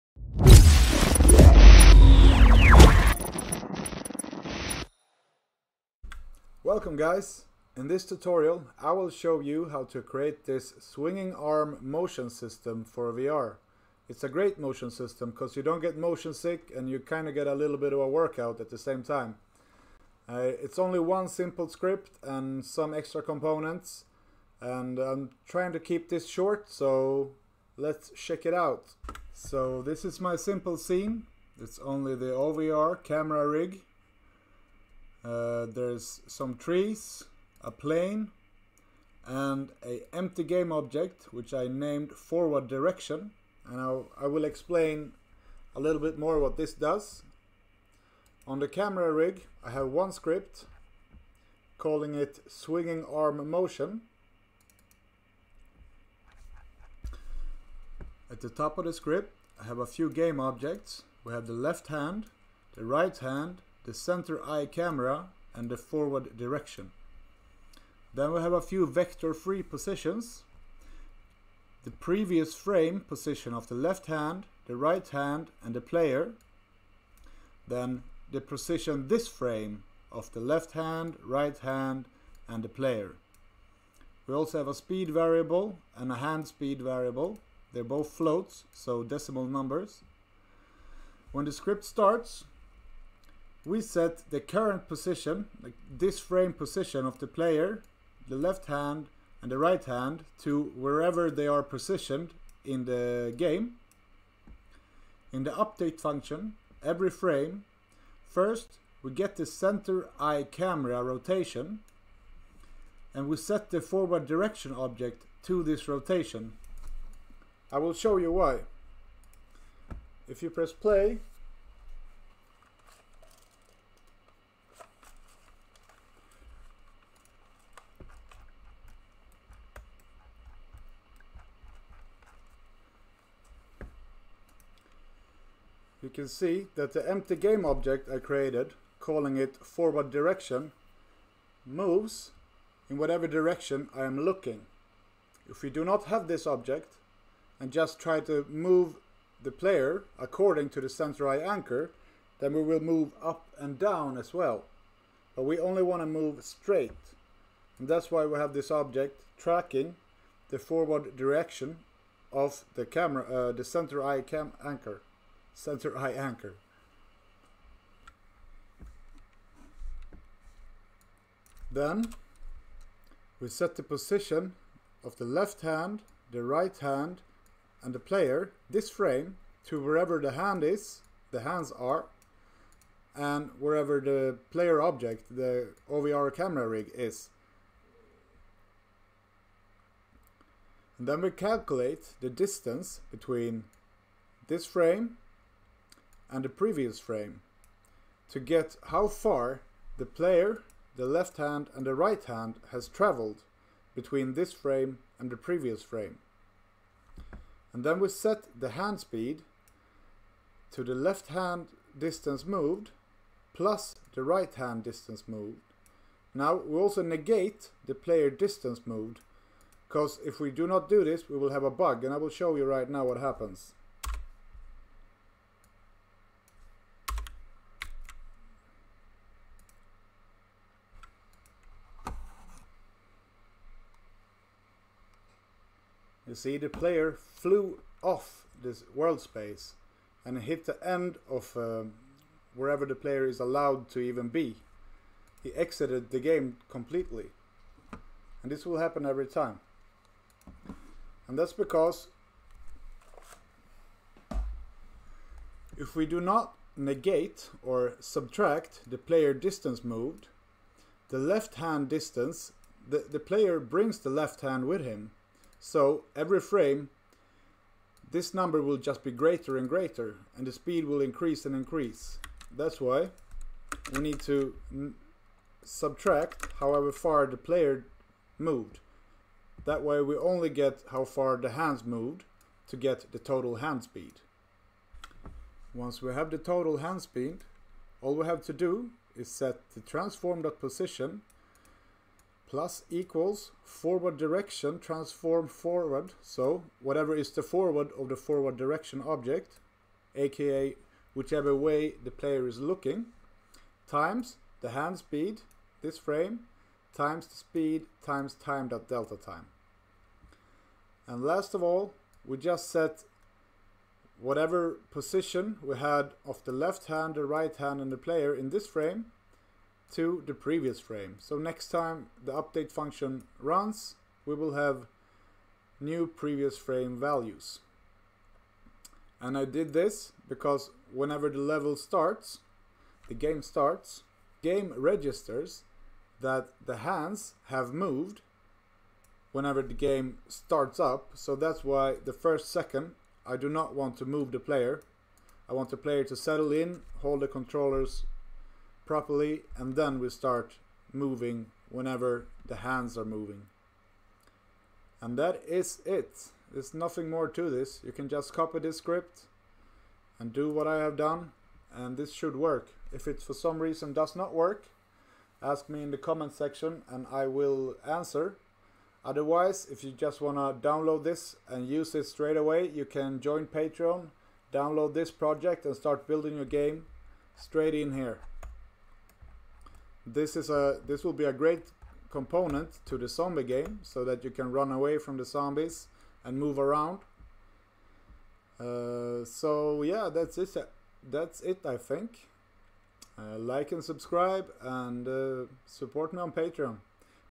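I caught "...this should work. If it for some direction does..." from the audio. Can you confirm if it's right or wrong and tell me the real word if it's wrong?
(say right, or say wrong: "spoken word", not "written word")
wrong: "reason", not "direction".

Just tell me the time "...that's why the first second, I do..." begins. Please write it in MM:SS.
05:41.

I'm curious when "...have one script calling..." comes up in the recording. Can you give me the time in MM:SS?
00:49.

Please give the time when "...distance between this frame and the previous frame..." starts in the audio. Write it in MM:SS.
03:12.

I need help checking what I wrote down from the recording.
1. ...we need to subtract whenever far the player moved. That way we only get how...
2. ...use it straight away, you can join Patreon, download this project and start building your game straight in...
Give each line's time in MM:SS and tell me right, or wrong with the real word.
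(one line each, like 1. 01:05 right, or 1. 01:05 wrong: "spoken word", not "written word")
1. 04:33 wrong: "however", not "whenever"
2. 06:11 right.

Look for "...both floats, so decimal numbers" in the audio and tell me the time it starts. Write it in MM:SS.
01:27.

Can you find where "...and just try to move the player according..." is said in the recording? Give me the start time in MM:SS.
02:27.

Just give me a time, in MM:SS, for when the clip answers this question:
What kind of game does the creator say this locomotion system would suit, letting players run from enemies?
06:23.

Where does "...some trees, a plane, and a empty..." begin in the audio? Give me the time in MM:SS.
00:36.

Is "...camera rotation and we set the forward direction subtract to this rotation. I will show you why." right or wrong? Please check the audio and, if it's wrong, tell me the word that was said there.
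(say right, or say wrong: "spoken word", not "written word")
wrong: "object", not "subtract".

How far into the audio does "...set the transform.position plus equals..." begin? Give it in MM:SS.
04:49.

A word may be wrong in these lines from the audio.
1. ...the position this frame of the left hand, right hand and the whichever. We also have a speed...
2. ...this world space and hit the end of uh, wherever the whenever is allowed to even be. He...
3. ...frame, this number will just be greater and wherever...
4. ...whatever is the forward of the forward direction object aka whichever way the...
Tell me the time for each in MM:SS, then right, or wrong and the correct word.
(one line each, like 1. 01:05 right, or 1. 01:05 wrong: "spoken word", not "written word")
1. 01:18 wrong: "player", not "whichever"
2. 03:58 wrong: "player", not "whenever"
3. 04:26 wrong: "greater", not "wherever"
4. 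04:56 right.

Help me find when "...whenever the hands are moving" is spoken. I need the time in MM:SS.
05:51.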